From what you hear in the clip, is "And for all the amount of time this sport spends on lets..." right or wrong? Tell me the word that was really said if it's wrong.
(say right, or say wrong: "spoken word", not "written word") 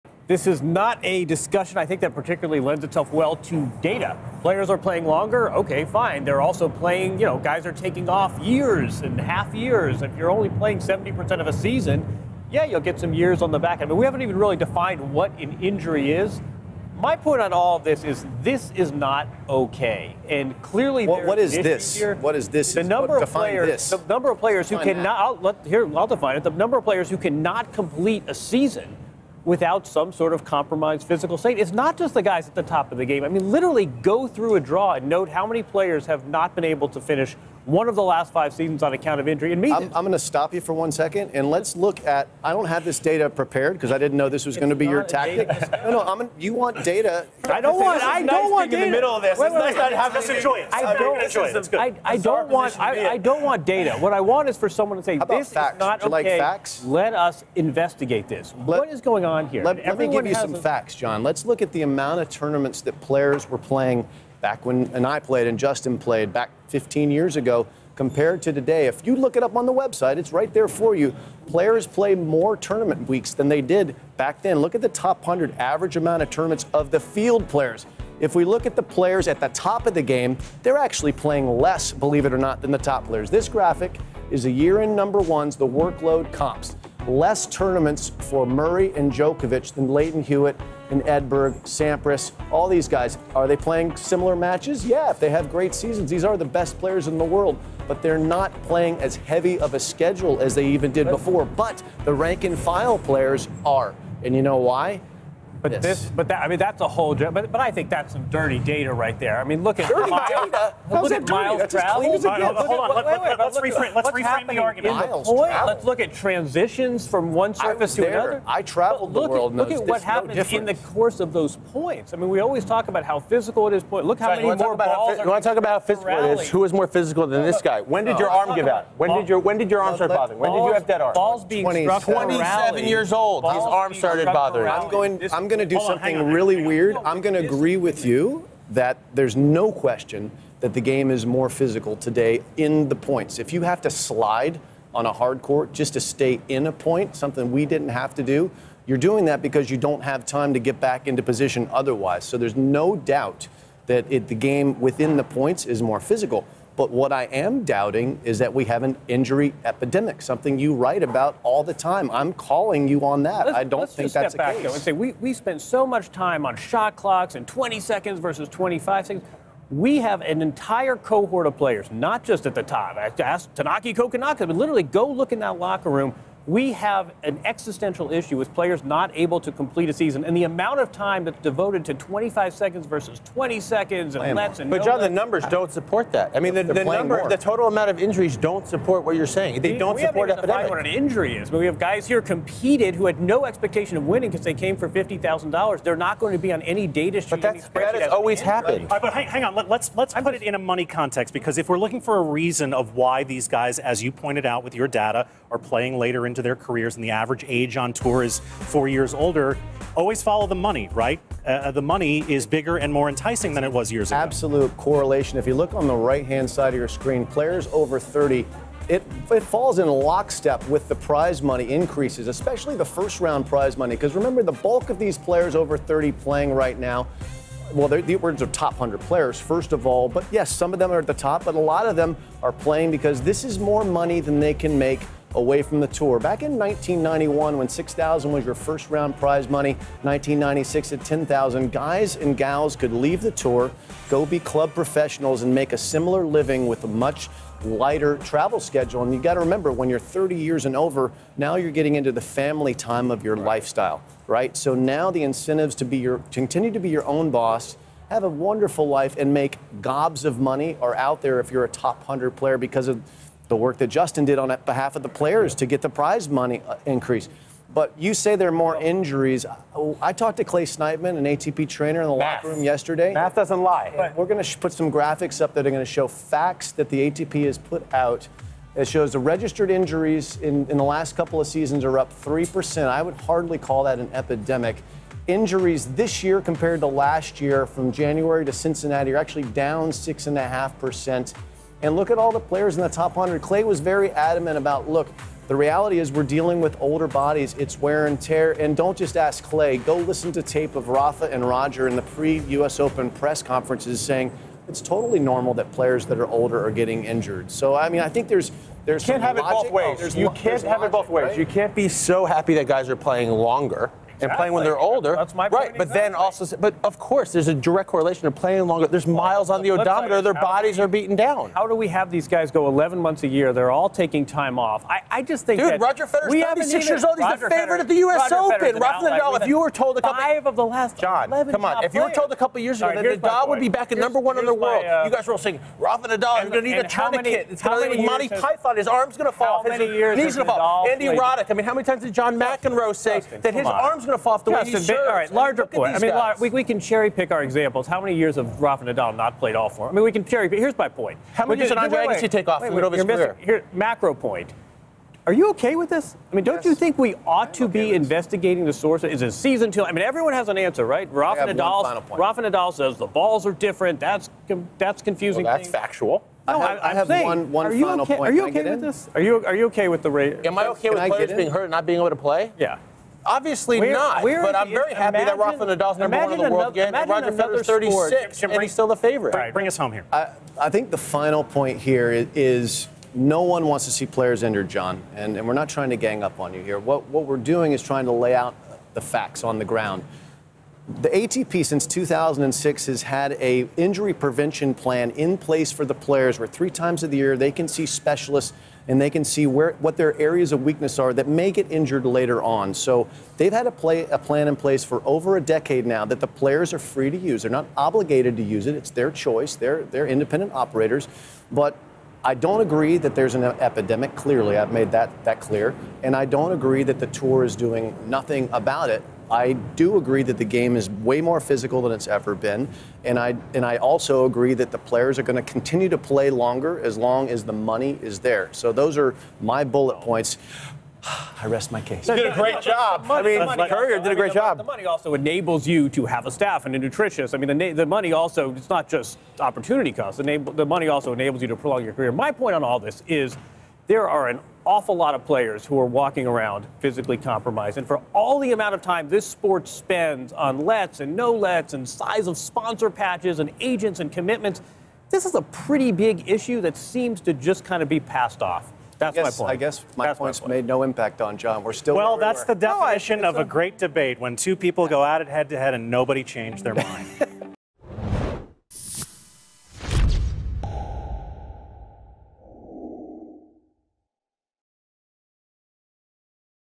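right.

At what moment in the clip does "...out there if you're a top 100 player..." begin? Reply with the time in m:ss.
4:20.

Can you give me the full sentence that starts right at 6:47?
They're not obligated to use it.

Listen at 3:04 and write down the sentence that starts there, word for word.
But no John, the numbers don't support that.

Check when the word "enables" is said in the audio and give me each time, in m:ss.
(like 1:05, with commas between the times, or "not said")
7:15, 7:21.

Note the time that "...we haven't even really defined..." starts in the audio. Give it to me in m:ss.
0:13.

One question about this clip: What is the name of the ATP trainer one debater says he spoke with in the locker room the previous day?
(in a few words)
Clay Sniteman.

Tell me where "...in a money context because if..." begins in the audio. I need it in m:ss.
3:20.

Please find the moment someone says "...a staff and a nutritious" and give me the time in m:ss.
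7:16.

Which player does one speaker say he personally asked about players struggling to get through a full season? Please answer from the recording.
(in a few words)
Thanasi Kokkinakis.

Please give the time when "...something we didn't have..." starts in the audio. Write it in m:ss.
2:27.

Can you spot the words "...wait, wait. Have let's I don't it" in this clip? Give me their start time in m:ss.
0:49.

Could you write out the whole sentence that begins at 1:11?
Players play more tournament weeks than they did back then.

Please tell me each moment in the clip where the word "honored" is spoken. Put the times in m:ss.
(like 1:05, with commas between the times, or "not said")
not said.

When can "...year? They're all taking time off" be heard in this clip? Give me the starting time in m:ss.
5:23.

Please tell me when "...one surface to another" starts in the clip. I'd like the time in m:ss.
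1:57.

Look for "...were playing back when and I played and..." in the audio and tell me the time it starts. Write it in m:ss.
1:03.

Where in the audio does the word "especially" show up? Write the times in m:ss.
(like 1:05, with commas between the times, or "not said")
3:42.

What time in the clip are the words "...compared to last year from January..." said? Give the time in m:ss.
4:46.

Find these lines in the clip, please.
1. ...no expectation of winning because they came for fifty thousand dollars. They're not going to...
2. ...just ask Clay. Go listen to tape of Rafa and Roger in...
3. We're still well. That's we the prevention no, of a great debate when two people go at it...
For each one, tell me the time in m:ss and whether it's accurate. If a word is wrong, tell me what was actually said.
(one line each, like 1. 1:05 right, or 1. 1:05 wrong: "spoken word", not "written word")
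1. 3:13 right
2. 4:58 right
3. 7:41 wrong: "definition", not "prevention".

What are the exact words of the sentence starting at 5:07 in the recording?
So I mean, I think there's there's you can't have logic.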